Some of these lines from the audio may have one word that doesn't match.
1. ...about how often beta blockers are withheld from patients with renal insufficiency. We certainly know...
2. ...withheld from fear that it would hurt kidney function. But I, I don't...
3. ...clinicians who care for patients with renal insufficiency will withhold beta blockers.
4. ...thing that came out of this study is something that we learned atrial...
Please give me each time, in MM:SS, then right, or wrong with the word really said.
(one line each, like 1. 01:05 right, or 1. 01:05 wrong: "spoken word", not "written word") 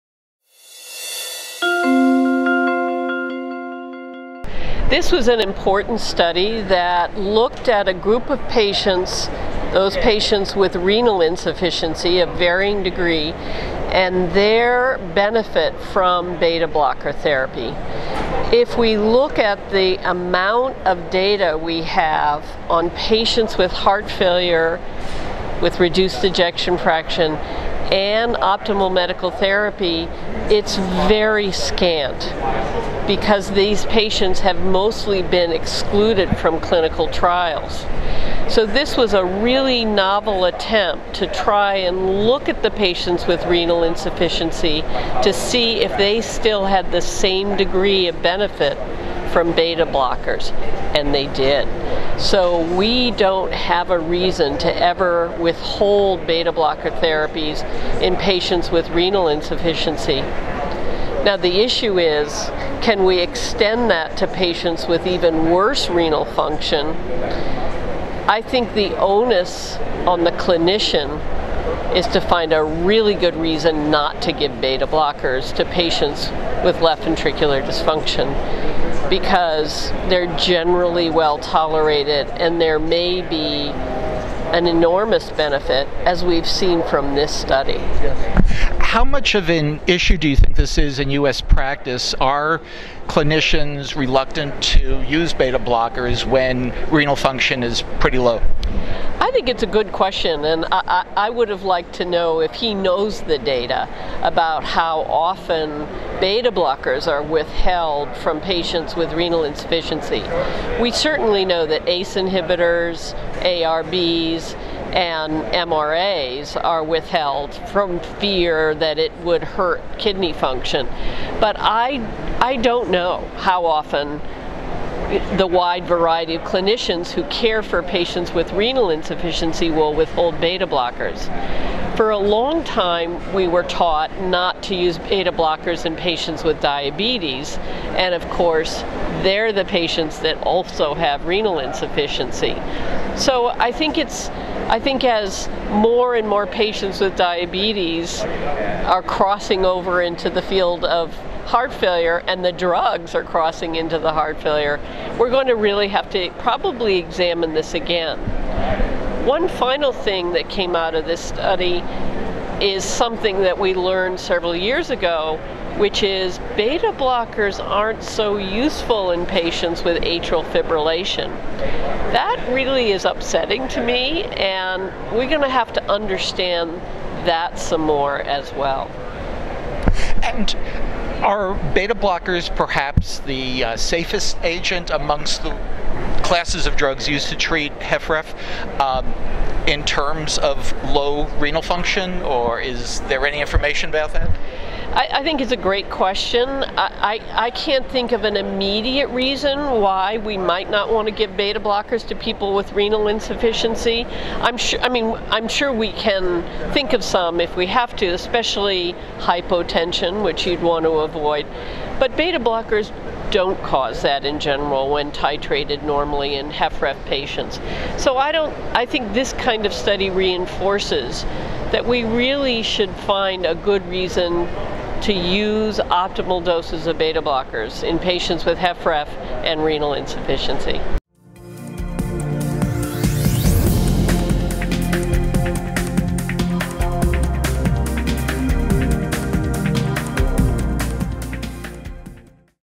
1. 01:44 right
2. 01:56 right
3. 02:06 right
4. 02:39 wrong: "several", not "atrial".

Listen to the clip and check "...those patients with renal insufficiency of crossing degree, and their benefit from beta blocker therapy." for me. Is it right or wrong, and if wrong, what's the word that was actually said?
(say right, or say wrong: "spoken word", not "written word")
wrong: "varying", not "crossing".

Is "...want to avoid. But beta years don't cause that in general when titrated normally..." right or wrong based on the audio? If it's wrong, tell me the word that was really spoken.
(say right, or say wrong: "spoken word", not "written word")
wrong: "blockers", not "years".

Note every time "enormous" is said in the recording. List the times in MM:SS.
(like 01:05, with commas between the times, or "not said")
01:24.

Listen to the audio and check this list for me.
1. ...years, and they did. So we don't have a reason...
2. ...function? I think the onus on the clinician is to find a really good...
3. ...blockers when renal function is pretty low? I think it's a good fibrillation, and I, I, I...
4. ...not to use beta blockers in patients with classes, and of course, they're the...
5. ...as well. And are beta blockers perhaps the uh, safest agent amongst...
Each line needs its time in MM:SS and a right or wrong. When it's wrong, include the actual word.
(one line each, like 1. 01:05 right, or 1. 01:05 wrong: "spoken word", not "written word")
1. 00:49 wrong: "blockers", not "years"
2. 01:06 right
3. 01:35 wrong: "question", not "fibrillation"
4. 02:14 wrong: "diabetes", not "classes"
5. 02:58 right.